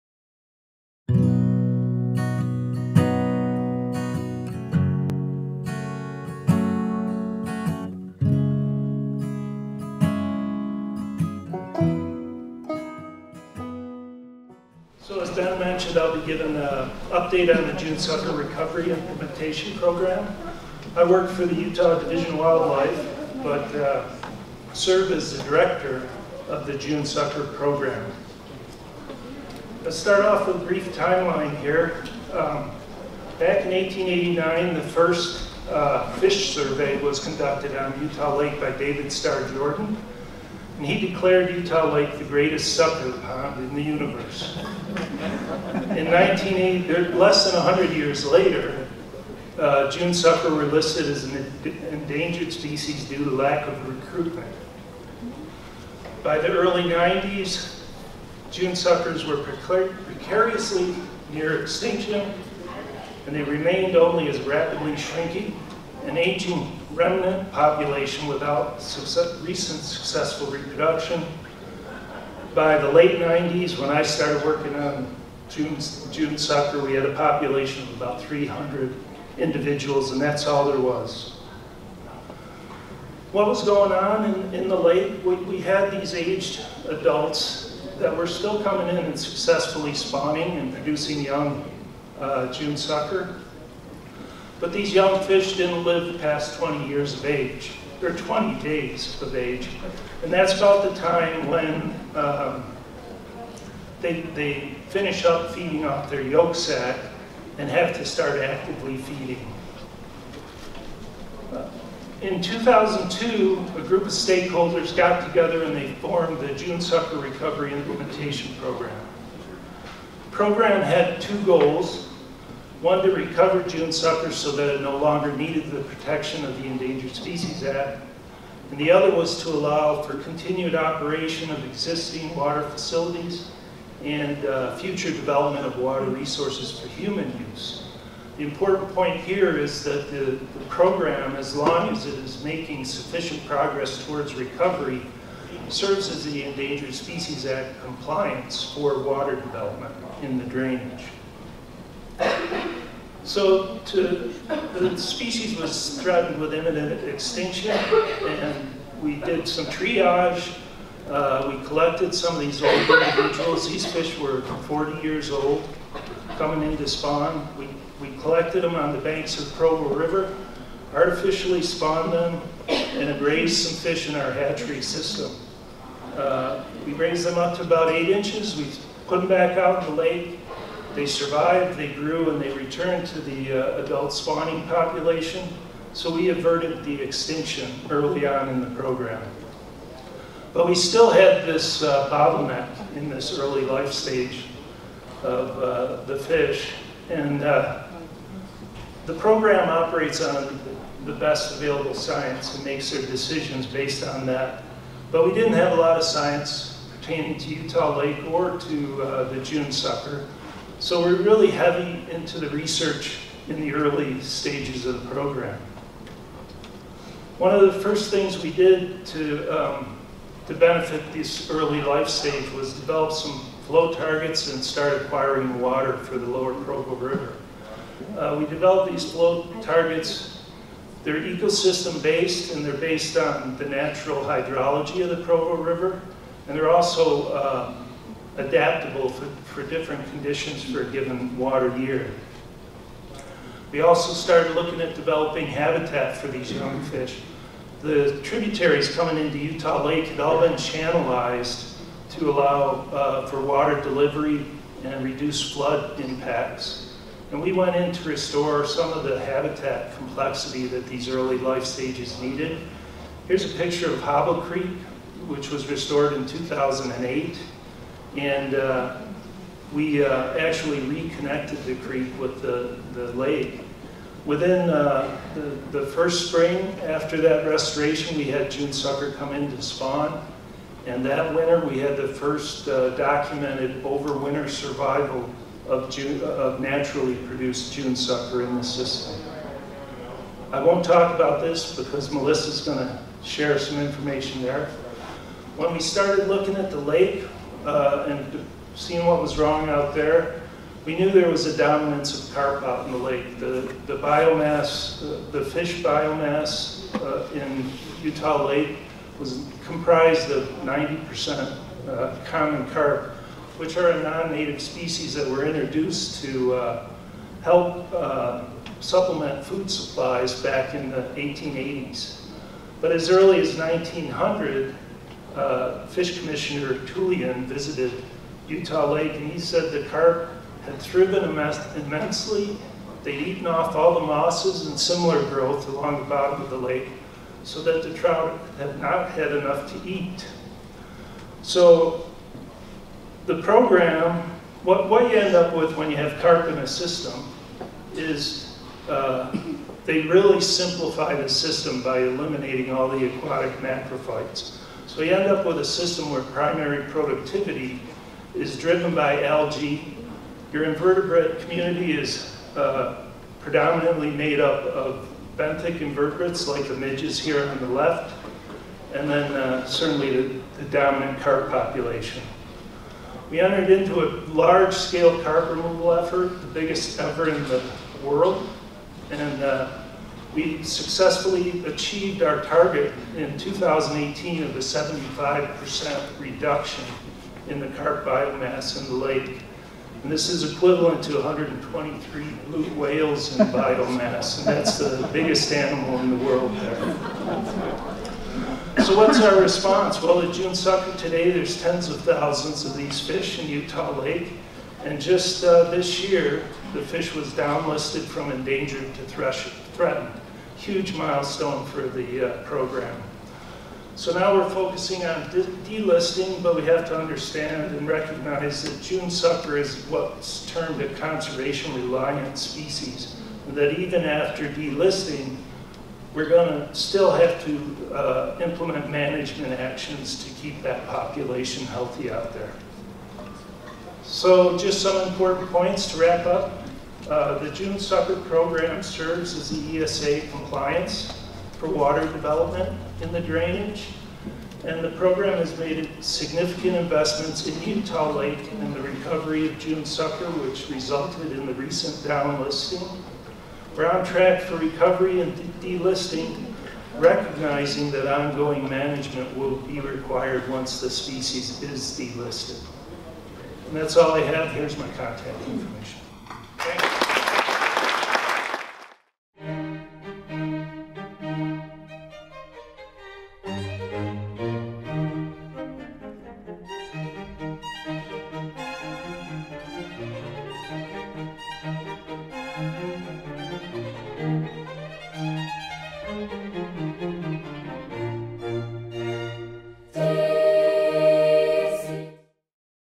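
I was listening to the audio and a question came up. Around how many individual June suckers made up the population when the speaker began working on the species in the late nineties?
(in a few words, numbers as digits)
300.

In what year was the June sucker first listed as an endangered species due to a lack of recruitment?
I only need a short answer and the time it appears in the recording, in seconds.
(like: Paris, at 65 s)
1980, at 46 s.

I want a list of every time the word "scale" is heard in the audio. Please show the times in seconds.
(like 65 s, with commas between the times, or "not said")
374 s.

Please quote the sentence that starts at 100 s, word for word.
And that's about the time when um, they, they finish up feeding off their yolk sac and have to start actively feeding.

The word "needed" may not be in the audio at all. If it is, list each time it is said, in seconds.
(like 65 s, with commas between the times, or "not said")
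125 s, 262 s.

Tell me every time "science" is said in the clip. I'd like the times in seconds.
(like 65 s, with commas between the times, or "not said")
201 s, 206 s.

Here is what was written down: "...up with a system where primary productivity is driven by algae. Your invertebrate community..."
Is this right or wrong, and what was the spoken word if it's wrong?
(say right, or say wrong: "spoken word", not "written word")
right.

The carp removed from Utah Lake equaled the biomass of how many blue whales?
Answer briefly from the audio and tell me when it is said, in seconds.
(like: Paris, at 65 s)
123, at 391 s.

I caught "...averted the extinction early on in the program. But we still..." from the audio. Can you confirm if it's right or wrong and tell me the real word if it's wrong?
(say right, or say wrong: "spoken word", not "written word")
right.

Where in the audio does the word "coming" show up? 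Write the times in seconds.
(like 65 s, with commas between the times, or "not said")
88 s, 166 s, 248 s.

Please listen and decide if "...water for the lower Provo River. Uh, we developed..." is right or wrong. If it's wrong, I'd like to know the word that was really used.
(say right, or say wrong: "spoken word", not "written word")
right.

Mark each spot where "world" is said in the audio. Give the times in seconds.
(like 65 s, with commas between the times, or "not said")
378 s, 396 s.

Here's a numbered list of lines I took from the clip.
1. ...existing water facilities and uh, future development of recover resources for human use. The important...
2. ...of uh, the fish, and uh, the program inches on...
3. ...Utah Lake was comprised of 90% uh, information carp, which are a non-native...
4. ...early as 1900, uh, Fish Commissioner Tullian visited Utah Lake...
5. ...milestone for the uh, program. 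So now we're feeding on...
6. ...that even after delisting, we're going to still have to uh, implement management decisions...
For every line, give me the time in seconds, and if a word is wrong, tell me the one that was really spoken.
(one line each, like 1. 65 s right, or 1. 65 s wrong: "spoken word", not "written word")
1. 131 s wrong: "water", not "recover"
2. 195 s wrong: "operates", not "inches"
3. 308 s wrong: "common", not "information"
4. 323 s right
5. 410 s wrong: "focusing", not "feeding"
6. 423 s wrong: "actions", not "decisions".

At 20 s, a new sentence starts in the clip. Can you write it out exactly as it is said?
I work for the Utah Division of Wildlife, but uh, serve as the director of the June Sucker Program.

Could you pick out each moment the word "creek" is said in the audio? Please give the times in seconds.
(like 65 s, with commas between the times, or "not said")
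264 s, 271 s.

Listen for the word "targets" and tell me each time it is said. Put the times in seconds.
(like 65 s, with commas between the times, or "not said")
223 s, 229 s, 382 s.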